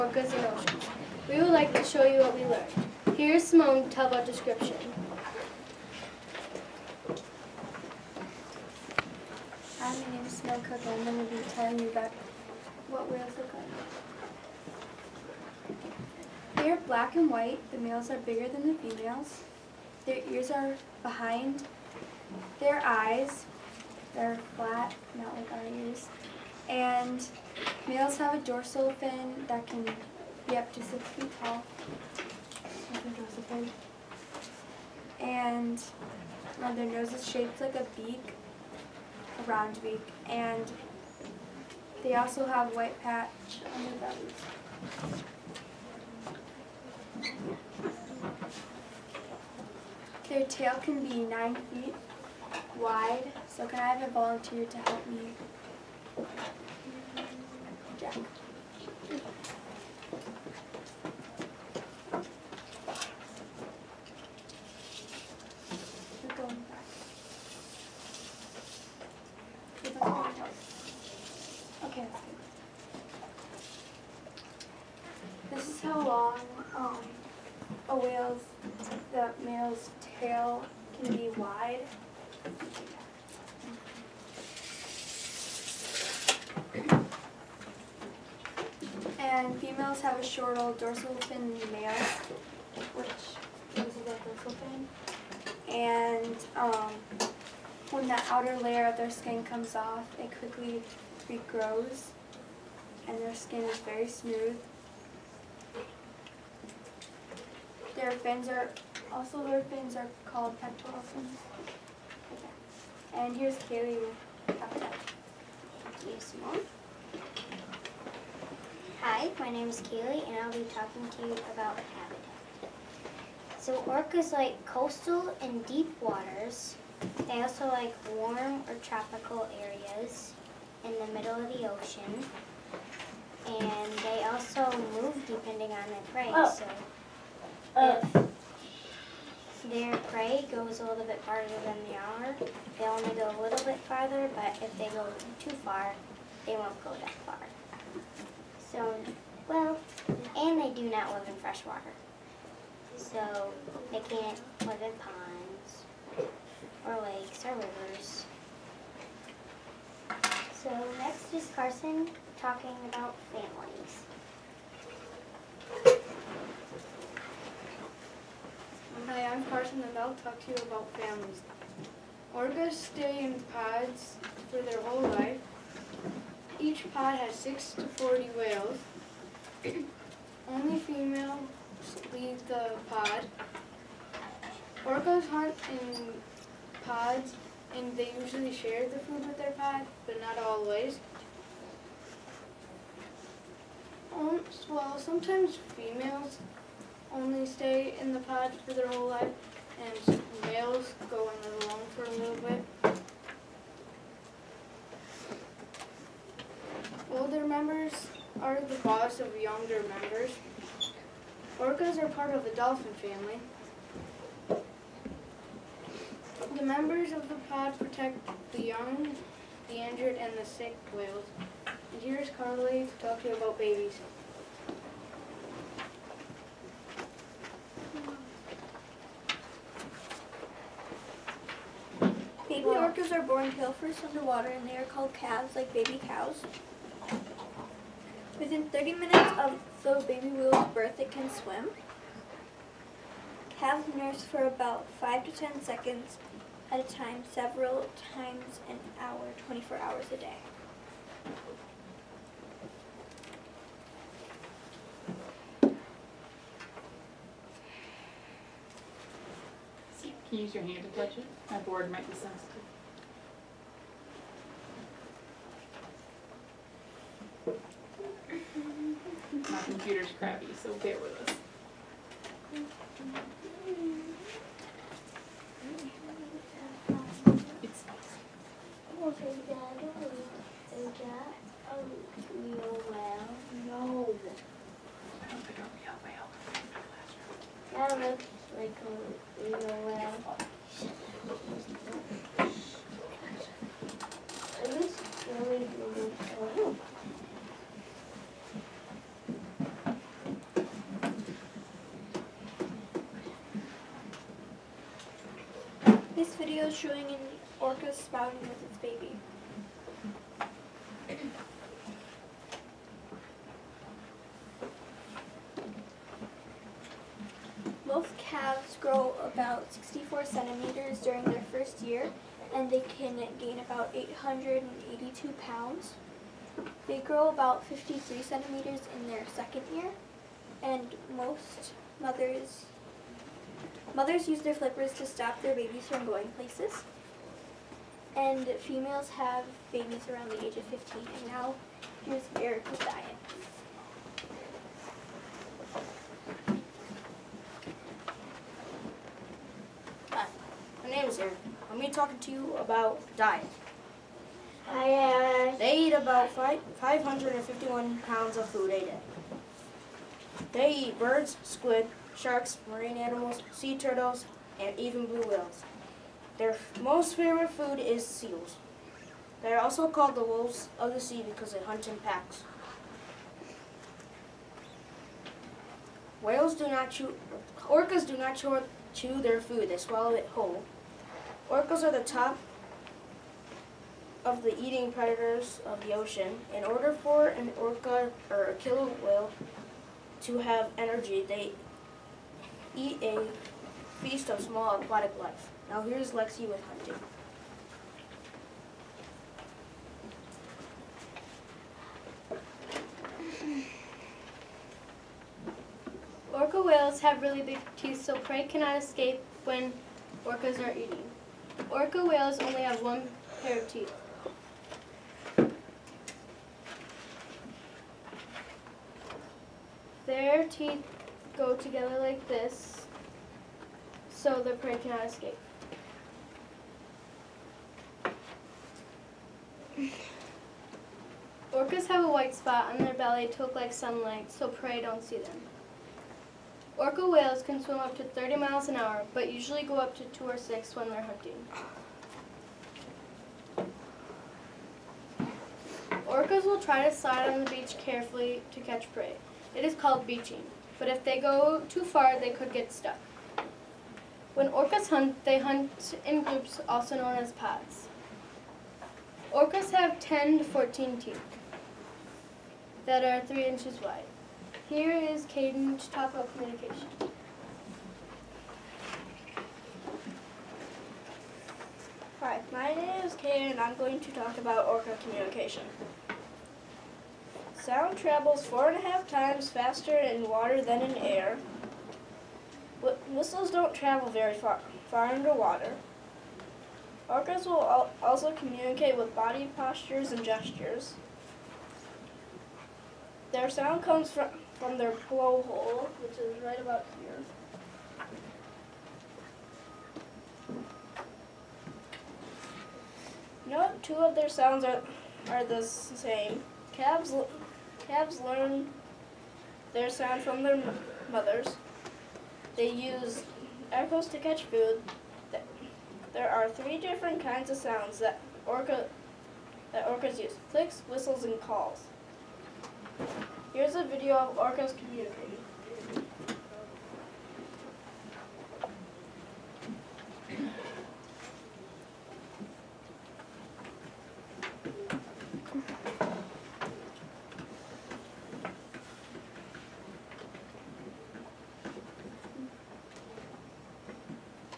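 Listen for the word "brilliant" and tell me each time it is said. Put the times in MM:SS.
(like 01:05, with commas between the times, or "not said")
not said.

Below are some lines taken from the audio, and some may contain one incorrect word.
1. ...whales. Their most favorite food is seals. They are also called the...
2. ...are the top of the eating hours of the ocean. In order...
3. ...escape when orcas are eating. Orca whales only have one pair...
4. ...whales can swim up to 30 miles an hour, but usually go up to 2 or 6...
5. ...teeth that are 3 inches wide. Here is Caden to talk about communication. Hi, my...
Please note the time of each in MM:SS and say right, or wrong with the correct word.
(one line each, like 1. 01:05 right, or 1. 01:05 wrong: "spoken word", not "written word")
1. 06:05 right
2. 06:21 wrong: "predators", not "hours"
3. 06:48 right
4. 07:17 right
5. 07:40 right.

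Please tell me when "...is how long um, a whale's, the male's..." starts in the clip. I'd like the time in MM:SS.
01:15.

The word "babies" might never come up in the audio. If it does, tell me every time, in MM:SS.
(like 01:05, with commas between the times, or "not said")
03:43, 05:35, 05:39.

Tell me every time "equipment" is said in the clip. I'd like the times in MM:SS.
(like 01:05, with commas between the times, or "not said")
not said.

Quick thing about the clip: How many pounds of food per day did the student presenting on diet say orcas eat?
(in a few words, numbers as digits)
551 pounds.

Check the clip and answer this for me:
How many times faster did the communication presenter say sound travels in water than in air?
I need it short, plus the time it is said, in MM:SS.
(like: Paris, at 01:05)
4.5, at 07:58.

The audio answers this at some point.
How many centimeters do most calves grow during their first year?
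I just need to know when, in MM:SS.
05:19.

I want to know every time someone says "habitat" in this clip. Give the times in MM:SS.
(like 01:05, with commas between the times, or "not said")
01:54, 02:01.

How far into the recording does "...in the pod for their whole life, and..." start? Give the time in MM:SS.
03:17.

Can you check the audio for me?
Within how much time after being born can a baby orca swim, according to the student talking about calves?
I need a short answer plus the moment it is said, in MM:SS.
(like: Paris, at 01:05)
30 minutes, at 03:58.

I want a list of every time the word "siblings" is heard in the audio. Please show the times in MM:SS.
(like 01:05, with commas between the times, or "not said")
not said.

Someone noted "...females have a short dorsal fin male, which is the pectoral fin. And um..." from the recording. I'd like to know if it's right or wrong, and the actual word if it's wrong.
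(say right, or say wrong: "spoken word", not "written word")
wrong: "dorsal", not "pectoral".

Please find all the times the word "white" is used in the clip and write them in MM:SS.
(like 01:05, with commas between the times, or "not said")
00:17, 00:42, 07:12.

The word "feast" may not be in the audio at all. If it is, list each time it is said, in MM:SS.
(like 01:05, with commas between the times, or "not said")
06:34.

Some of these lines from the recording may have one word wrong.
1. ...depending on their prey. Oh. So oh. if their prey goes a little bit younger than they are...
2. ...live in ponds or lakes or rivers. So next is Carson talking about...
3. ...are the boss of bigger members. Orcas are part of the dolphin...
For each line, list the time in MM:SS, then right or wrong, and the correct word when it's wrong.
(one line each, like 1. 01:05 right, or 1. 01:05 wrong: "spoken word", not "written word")
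1. 02:15 wrong: "farther", not "younger"
2. 02:34 right
3. 03:28 wrong: "younger", not "bigger".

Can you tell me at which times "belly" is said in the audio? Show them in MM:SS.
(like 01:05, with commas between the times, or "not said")
00:43, 07:12.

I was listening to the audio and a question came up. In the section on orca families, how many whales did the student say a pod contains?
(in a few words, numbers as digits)
6 to 40.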